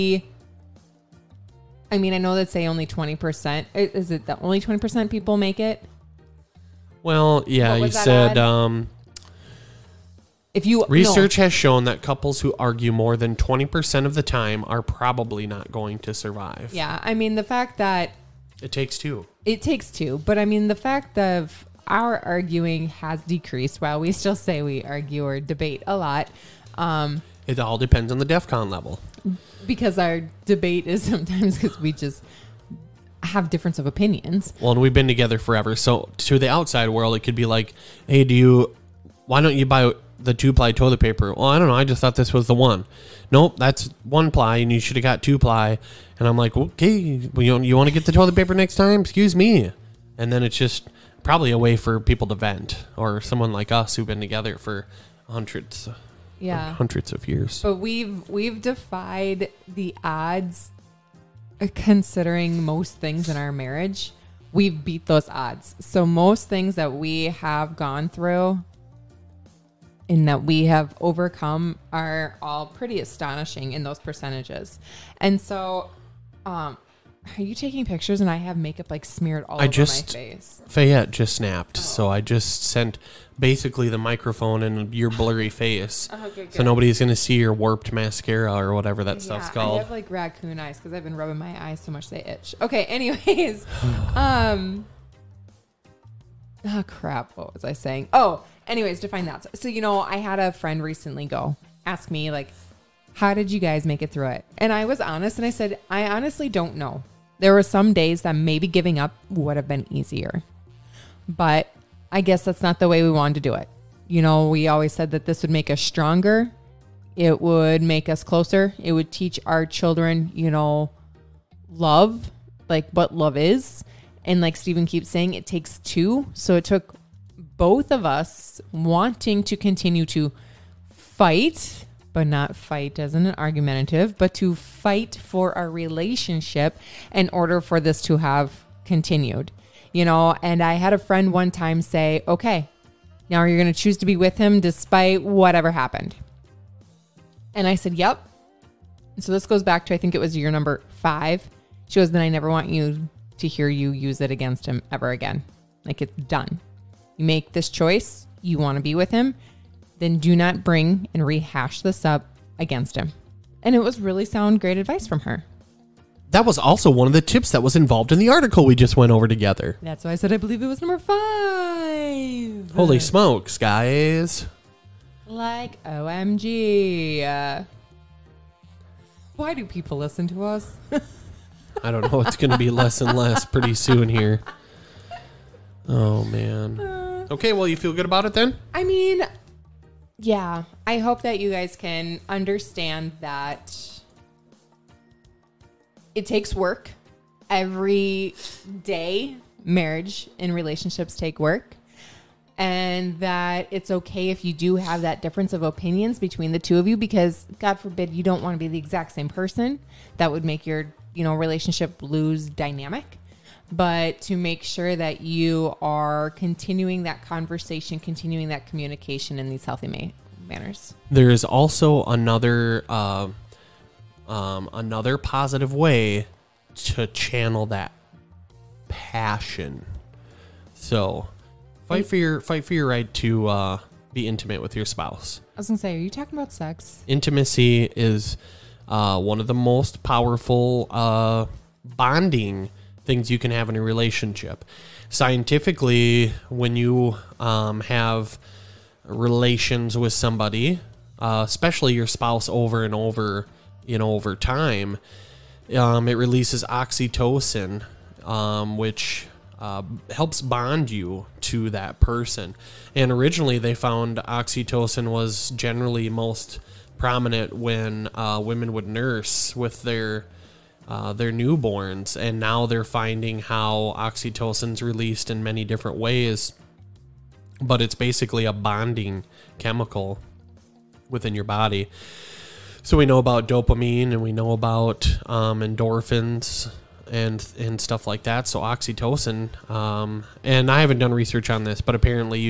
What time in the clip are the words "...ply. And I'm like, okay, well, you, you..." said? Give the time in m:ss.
0:45.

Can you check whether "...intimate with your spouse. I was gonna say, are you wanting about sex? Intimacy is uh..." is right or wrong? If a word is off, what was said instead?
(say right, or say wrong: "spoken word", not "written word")
wrong: "talking", not "wanting".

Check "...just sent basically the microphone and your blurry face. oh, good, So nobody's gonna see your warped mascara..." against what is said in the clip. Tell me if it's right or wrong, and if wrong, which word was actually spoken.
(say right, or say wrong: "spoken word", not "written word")
right.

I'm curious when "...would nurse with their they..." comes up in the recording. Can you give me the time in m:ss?
4:28.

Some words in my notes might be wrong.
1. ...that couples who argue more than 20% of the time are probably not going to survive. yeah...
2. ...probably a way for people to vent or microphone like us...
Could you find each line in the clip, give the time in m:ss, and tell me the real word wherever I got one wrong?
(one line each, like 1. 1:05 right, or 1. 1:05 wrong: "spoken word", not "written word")
1. 0:11 right
2. 0:51 wrong: "someone", not "microphone".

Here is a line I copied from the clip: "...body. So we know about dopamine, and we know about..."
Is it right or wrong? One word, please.
right.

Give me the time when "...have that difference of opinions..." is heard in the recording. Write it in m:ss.
3:24.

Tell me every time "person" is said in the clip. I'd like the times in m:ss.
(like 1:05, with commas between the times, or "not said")
3:29, 4:21.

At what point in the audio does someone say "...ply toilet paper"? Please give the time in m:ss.
0:40.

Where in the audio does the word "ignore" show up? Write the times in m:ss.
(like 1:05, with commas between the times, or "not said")
not said.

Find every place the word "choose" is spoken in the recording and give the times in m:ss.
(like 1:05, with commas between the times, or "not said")
2:23.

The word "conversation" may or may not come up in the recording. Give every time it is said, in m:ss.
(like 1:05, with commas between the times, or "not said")
3:37.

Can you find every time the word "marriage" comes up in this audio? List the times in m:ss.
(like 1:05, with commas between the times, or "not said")
1:03, 3:19.